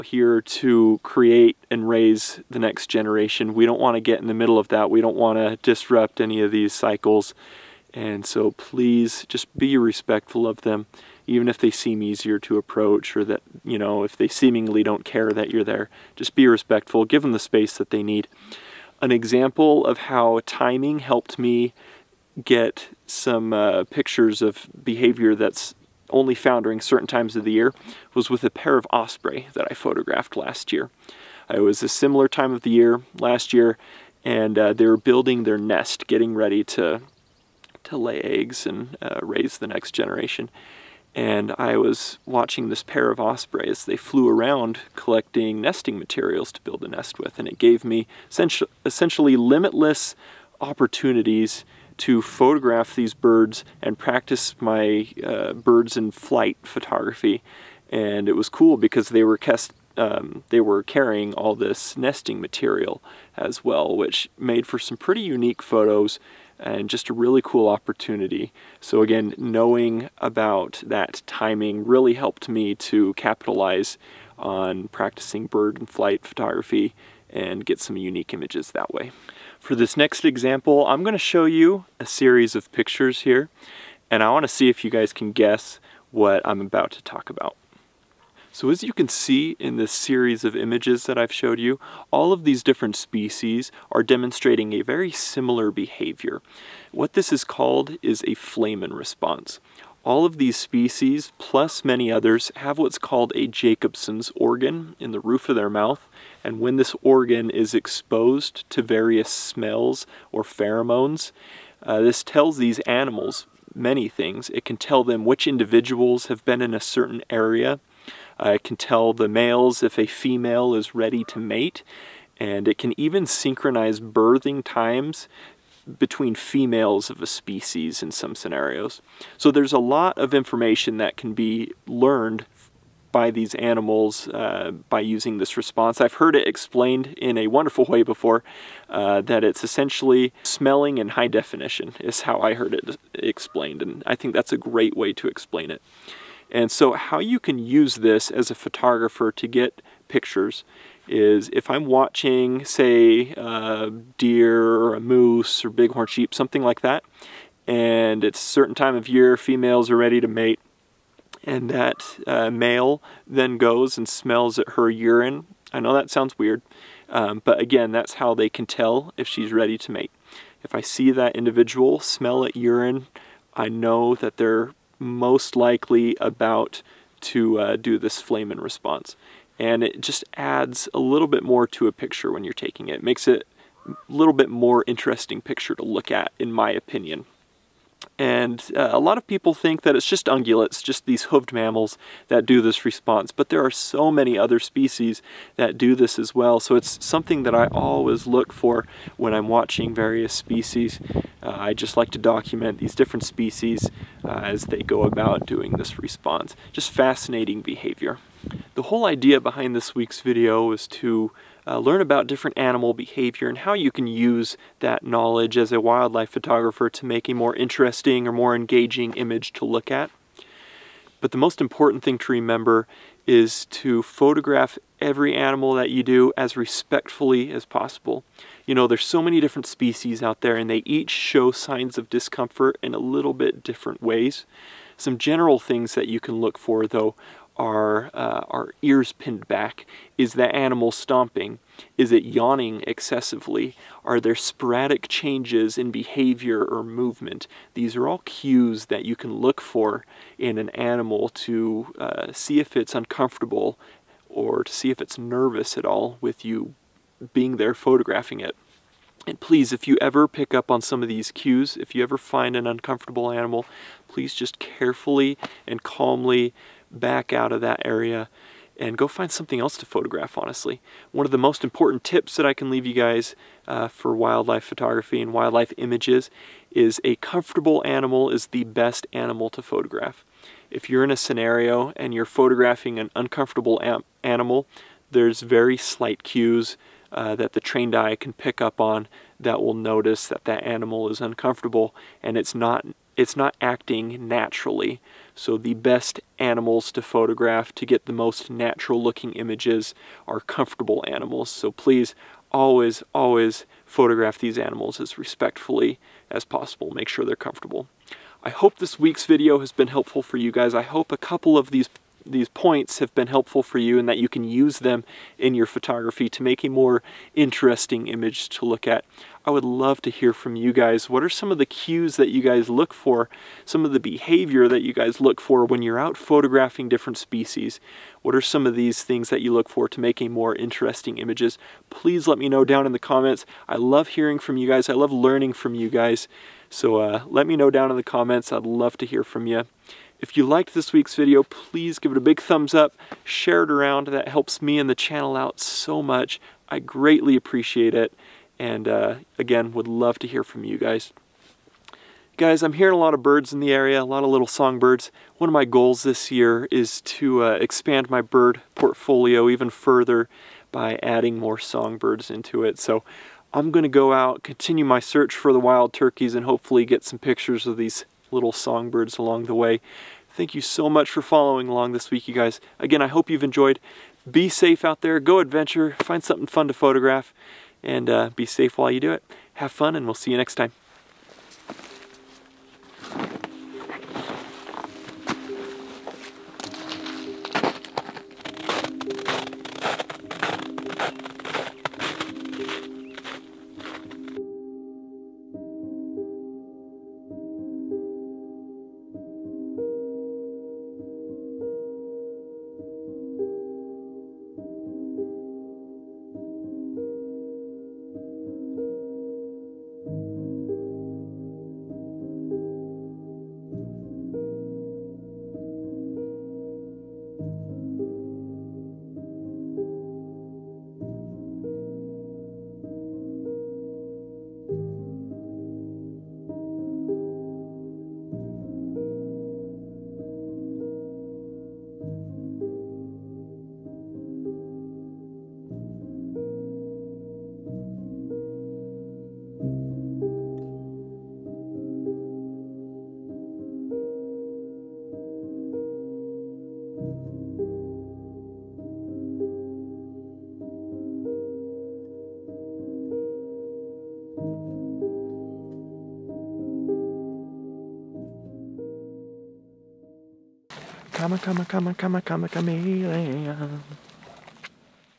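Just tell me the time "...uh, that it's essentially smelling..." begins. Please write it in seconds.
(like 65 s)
138 s.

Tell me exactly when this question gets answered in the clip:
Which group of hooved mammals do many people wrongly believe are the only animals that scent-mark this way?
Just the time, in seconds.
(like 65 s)
190 s.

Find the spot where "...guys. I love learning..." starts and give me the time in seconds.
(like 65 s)
334 s.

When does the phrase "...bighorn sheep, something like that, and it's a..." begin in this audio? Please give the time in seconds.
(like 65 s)
155 s.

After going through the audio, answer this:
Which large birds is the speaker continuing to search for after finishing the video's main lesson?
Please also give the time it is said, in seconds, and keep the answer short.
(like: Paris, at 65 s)
Wild turkeys, at 365 s.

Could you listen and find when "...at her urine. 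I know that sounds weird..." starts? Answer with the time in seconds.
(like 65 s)
164 s.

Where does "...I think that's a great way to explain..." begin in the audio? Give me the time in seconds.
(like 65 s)
144 s.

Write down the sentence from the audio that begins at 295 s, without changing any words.
So the best animals to photograph to get the most natural looking images are comfortable animals.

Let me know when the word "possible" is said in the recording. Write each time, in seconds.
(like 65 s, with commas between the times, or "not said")
227 s, 306 s.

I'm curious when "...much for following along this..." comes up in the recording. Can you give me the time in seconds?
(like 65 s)
370 s.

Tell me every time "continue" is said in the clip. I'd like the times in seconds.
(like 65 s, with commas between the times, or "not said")
364 s.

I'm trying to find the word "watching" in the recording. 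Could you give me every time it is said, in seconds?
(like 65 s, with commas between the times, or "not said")
42 s, 151 s, 199 s.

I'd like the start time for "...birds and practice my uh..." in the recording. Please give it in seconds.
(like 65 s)
53 s.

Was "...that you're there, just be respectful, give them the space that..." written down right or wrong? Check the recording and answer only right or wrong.
right.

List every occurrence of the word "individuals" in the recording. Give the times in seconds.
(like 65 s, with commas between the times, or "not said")
115 s, 171 s.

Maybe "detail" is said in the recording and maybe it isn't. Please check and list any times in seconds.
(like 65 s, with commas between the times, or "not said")
not said.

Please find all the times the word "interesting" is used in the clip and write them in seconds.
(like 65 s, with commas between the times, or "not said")
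184 s, 217 s, 317 s, 330 s.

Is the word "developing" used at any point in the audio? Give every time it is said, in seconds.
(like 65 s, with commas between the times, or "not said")
not said.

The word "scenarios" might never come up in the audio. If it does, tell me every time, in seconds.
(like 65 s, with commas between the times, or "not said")
128 s, 281 s.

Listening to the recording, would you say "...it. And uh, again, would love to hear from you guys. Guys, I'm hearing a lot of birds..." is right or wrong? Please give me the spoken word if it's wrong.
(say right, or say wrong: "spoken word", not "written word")
right.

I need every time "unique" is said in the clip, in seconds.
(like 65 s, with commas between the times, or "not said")
65 s, 77 s.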